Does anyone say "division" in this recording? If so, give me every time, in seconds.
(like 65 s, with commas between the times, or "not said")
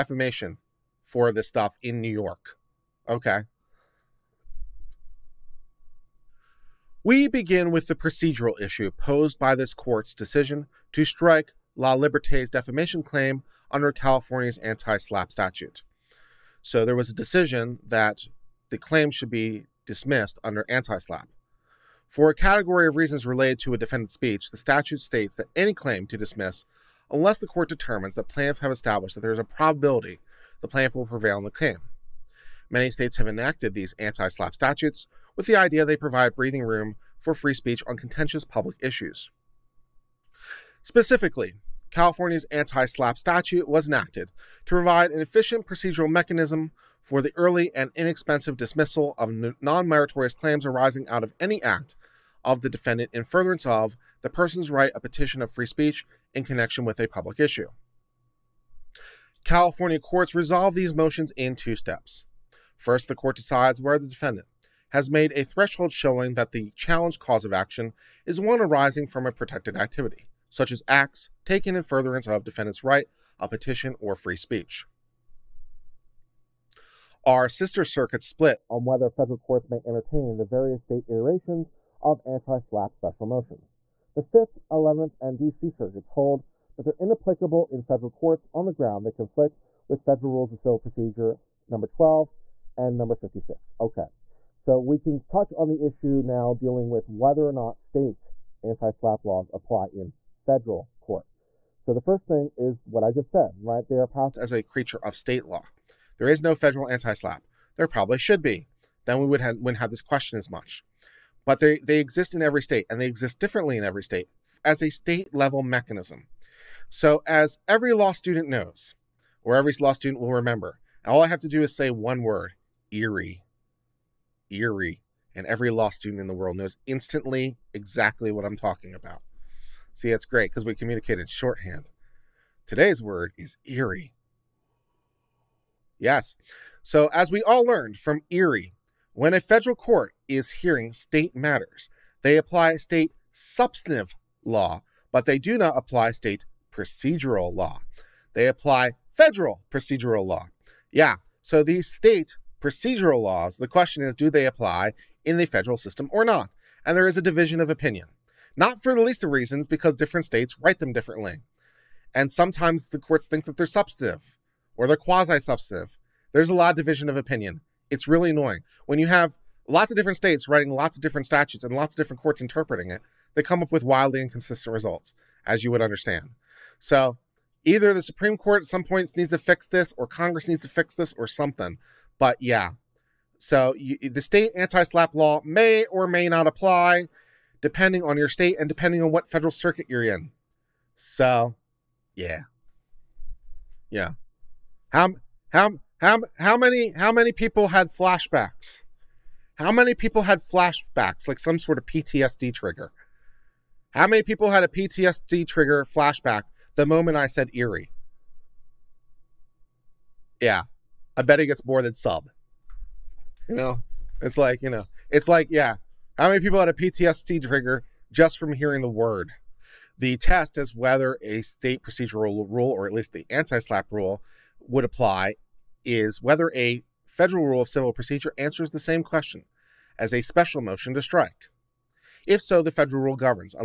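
157 s, 166 s.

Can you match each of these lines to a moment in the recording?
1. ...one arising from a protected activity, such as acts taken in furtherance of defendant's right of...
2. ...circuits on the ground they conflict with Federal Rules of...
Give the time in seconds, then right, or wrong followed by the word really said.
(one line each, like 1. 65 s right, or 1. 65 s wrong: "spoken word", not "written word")
1. 68 s right
2. 88 s wrong: "courts", not "circuits".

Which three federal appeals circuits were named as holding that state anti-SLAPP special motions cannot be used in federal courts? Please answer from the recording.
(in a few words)
5th, 11th, and DC.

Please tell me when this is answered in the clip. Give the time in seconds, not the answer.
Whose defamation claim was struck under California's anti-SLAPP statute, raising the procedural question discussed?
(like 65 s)
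11 s.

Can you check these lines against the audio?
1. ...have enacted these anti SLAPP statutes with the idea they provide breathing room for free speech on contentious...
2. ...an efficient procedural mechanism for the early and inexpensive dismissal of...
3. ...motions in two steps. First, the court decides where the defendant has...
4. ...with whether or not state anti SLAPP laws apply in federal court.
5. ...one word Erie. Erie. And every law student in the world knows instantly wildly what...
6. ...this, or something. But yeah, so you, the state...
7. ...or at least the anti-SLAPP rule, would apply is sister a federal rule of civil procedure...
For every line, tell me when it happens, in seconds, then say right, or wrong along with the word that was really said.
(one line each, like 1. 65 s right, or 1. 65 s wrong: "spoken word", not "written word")
1. 33 s right
2. 45 s right
3. 60 s right
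4. 96 s right
5. 121 s wrong: "exactly", not "wildly"
6. 180 s right
7. 222 s wrong: "whether", not "sister".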